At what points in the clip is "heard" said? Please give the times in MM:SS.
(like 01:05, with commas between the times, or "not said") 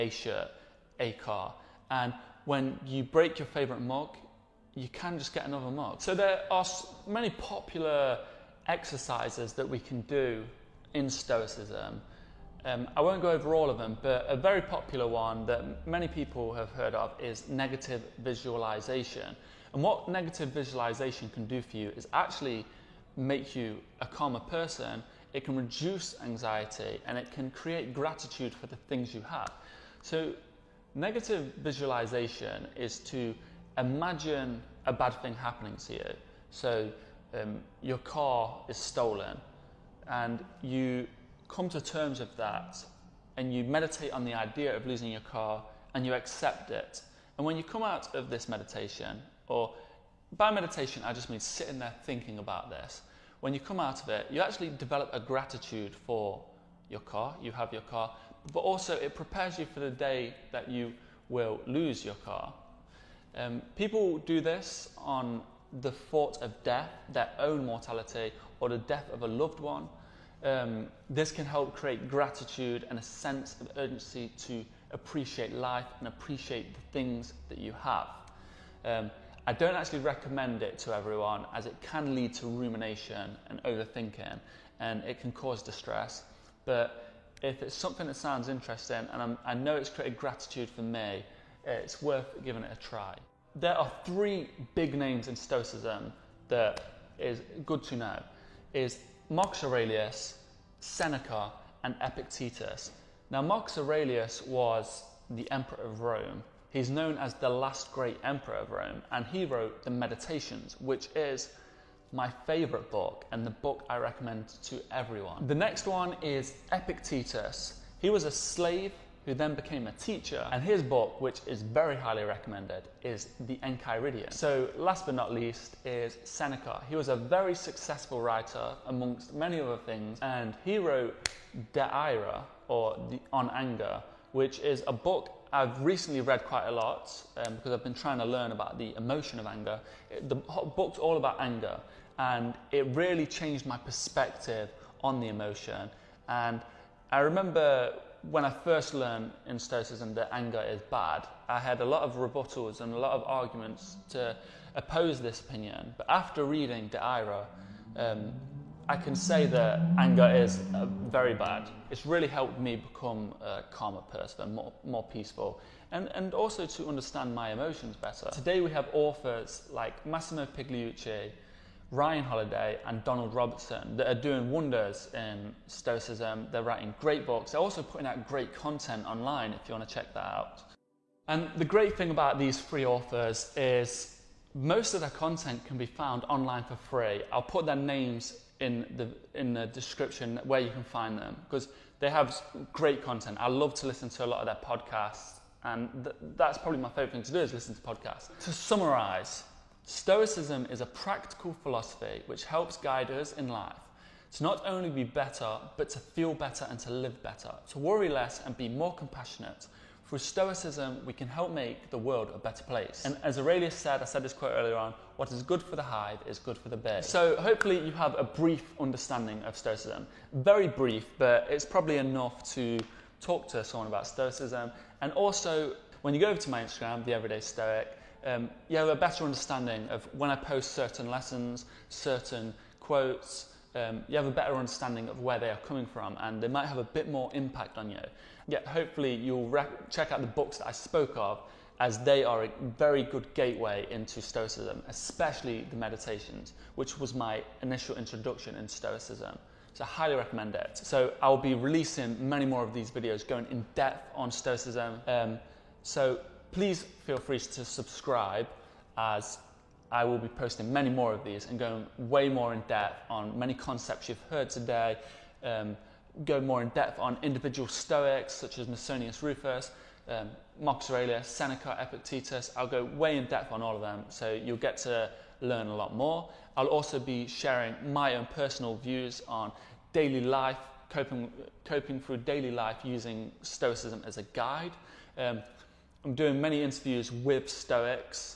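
00:16, 04:24.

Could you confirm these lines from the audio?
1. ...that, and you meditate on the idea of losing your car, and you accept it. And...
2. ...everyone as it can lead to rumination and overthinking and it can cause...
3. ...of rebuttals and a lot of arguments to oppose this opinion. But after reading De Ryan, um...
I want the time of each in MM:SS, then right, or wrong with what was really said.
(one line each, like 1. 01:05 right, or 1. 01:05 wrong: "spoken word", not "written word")
1. 00:42 right
2. 01:20 right
3. 02:32 wrong: "Ira", not "Ryan".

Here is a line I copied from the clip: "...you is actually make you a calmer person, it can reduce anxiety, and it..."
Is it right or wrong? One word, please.
right.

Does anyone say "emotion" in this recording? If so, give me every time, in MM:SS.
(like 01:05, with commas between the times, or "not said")
02:18, 02:25, 02:47.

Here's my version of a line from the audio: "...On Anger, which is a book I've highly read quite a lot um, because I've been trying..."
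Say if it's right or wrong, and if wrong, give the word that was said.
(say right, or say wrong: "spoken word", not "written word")
wrong: "recently", not "highly".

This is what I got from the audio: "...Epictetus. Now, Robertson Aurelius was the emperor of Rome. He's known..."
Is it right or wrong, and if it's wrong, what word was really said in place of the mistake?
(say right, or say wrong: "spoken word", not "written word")
wrong: "Marcus", not "Robertson".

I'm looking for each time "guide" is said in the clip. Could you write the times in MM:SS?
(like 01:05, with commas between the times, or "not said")
03:22, 04:44.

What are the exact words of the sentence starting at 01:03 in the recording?
Um, people do this on the thought of death, their own mortality, or the death of a loved one.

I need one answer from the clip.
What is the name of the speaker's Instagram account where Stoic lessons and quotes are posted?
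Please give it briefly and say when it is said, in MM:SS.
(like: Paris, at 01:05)
The Everyday Stoic, at 03:47.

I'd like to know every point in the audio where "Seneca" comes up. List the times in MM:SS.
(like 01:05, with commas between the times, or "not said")
01:40, 02:06, 04:31.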